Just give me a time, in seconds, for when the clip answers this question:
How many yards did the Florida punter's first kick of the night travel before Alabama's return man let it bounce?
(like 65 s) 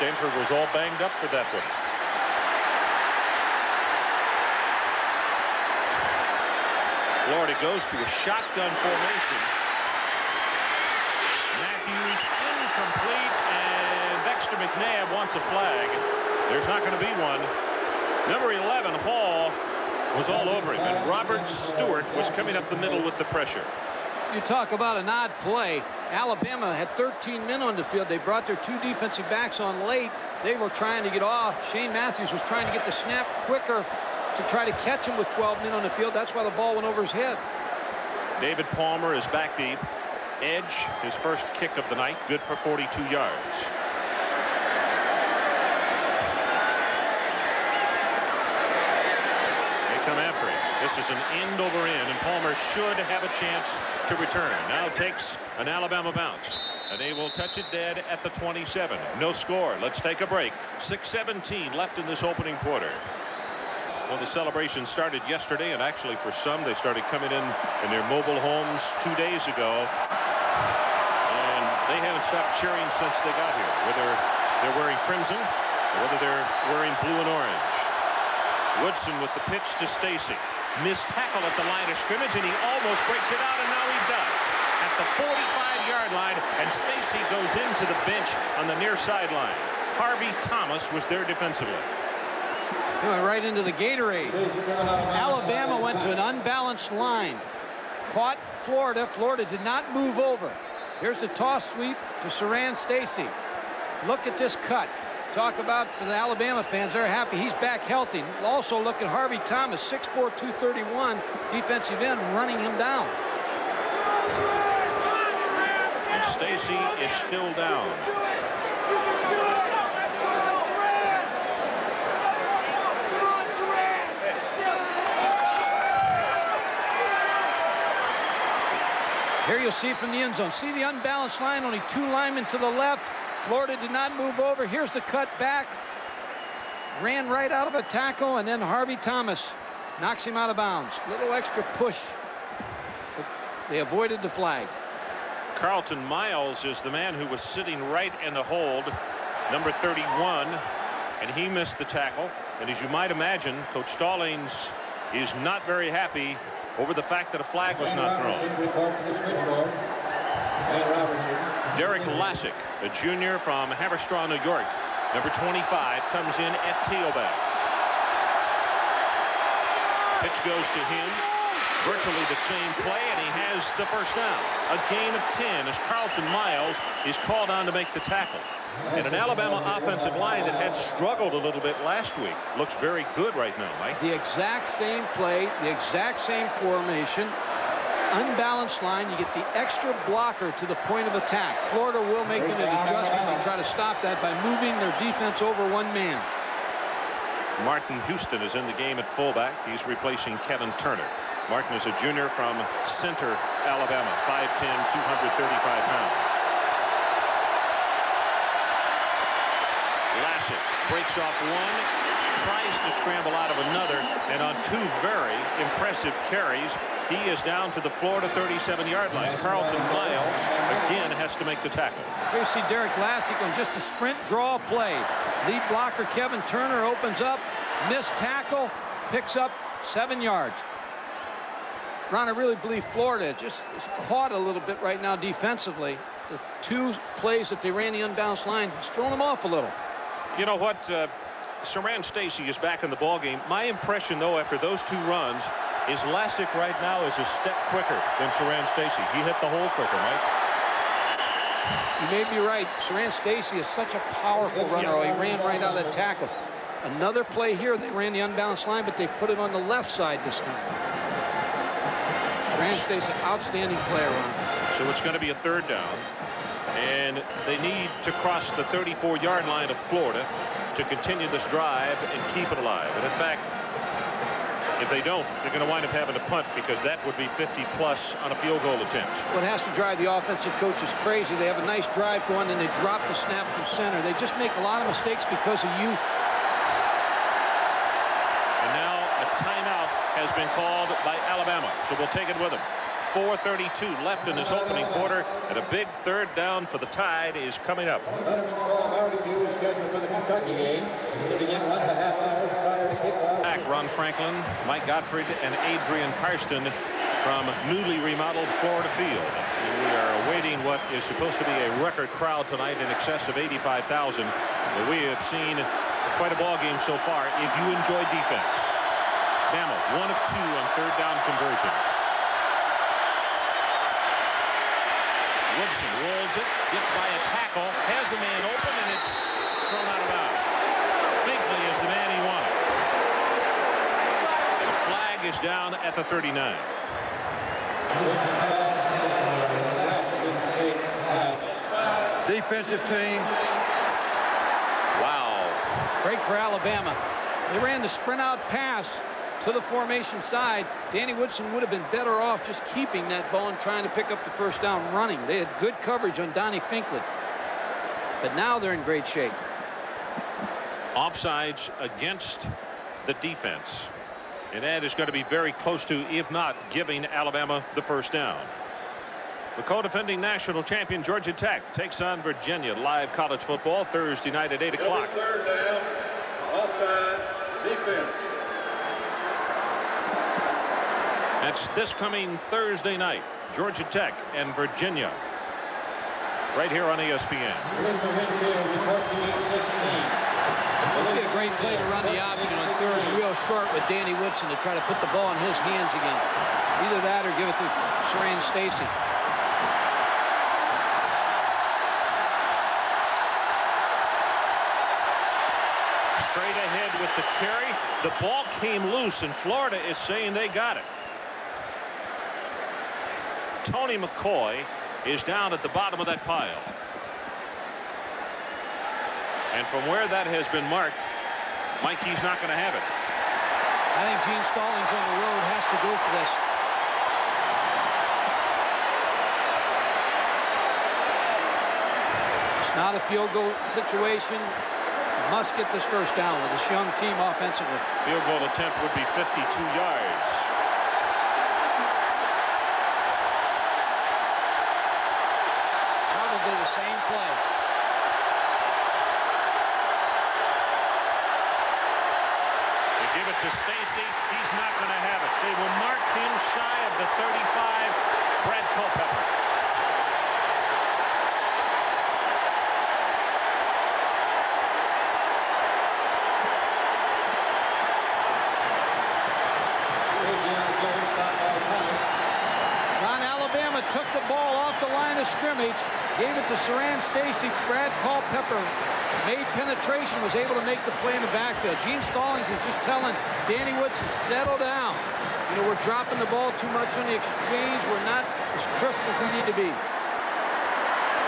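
42 s.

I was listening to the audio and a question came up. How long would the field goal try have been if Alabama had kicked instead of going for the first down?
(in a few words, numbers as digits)
52 yards.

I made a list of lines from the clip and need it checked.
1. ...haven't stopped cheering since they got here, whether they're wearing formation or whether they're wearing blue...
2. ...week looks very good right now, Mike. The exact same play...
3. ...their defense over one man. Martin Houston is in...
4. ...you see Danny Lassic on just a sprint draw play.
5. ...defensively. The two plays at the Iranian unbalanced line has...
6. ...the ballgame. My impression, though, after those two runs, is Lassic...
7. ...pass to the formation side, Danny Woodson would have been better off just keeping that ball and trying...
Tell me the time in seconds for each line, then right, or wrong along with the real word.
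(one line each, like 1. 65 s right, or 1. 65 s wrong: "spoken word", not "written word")
1. 72 s wrong: "crimson", not "formation"
2. 182 s right
3. 194 s right
4. 222 s wrong: "Derek", not "Danny"
5. 235 s right
6. 242 s right
7. 348 s right.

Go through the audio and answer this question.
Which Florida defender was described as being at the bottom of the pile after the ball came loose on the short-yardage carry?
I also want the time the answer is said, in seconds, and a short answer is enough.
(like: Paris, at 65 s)
Tony McCoy, at 413 s.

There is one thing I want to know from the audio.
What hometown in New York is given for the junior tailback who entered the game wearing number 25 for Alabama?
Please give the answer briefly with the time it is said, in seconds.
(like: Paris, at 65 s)
Haverstraw, at 163 s.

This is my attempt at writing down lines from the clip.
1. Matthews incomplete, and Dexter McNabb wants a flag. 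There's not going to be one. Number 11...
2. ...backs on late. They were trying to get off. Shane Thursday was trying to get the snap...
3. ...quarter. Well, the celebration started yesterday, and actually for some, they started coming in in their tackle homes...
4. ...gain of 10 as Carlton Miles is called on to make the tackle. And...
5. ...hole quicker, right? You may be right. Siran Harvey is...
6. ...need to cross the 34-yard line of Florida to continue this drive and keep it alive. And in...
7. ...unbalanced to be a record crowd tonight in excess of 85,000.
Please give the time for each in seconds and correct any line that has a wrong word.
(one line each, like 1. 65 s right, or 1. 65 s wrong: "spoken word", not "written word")
1. 11 s right
2. 29 s wrong: "Matthews", not "Thursday"
3. 62 s wrong: "mobile", not "tackle"
4. 174 s right
5. 249 s wrong: "Stacy", not "Harvey"
6. 267 s right
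7. 311 s wrong: "supposed", not "unbalanced".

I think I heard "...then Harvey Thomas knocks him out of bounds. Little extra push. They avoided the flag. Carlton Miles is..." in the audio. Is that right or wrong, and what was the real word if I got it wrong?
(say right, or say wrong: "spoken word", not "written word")
right.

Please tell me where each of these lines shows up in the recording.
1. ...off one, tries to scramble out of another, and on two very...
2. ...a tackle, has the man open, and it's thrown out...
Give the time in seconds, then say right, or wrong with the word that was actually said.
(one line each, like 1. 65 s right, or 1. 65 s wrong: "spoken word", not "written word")
1. 211 s right
2. 327 s right.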